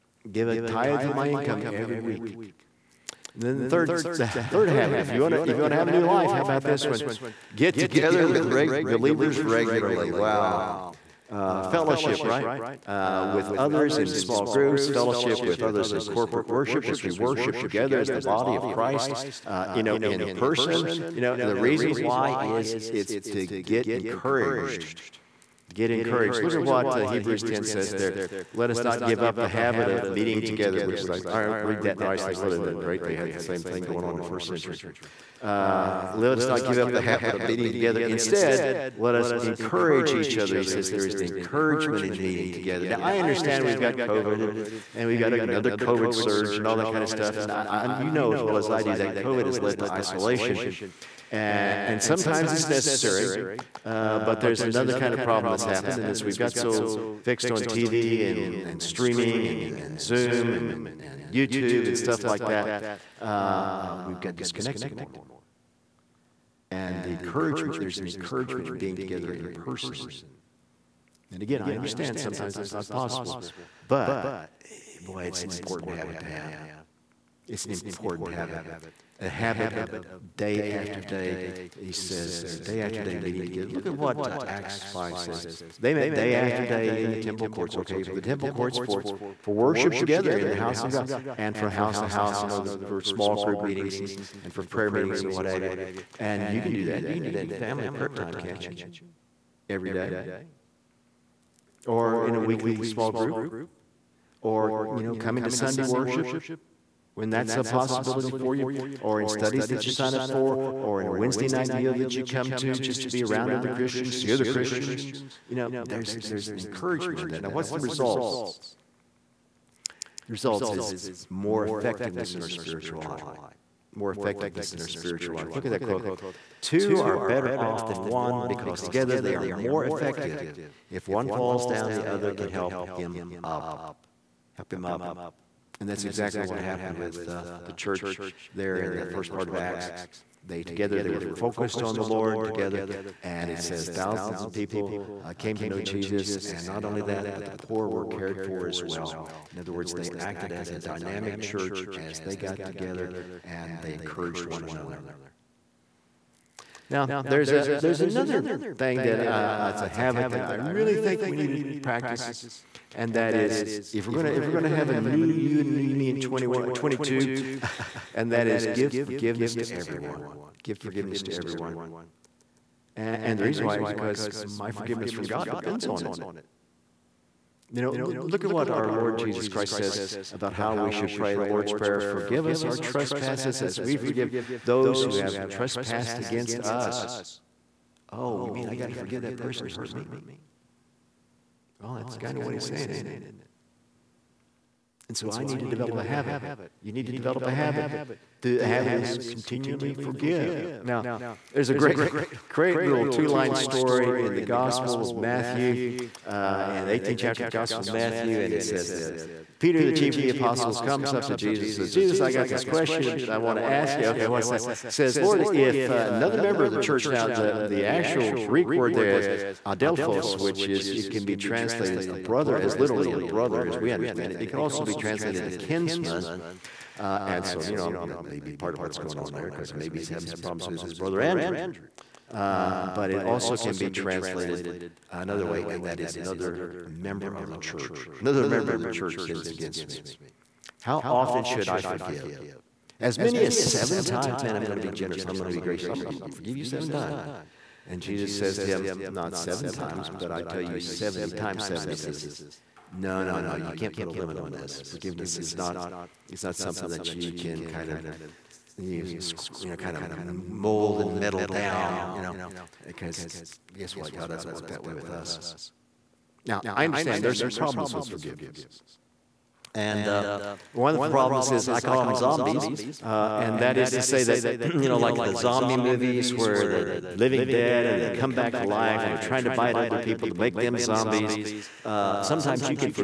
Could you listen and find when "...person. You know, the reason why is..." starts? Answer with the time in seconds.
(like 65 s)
20 s.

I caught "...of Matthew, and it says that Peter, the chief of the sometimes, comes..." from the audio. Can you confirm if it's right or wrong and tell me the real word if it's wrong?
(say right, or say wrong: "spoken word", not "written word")
wrong: "apostles", not "sometimes".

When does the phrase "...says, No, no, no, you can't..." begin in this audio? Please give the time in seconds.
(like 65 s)
251 s.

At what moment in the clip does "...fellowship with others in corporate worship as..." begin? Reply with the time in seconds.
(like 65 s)
14 s.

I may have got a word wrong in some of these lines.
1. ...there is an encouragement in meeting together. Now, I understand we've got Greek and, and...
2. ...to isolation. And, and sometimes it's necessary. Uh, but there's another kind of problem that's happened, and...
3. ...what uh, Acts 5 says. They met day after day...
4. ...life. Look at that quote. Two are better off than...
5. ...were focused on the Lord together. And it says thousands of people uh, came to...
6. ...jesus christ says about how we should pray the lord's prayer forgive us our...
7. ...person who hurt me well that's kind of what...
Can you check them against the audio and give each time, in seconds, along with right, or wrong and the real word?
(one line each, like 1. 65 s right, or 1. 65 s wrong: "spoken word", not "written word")
1. 40 s wrong: "COVID", not "Greek"
2. 49 s right
3. 83 s right
4. 125 s right
5. 141 s right
6. 179 s right
7. 189 s right.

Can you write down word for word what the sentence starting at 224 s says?
It can also be translated a kinsman.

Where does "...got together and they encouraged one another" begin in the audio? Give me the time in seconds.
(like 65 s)
152 s.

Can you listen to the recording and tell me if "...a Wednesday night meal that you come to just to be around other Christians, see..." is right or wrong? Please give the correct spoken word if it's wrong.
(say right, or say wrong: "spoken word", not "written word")
right.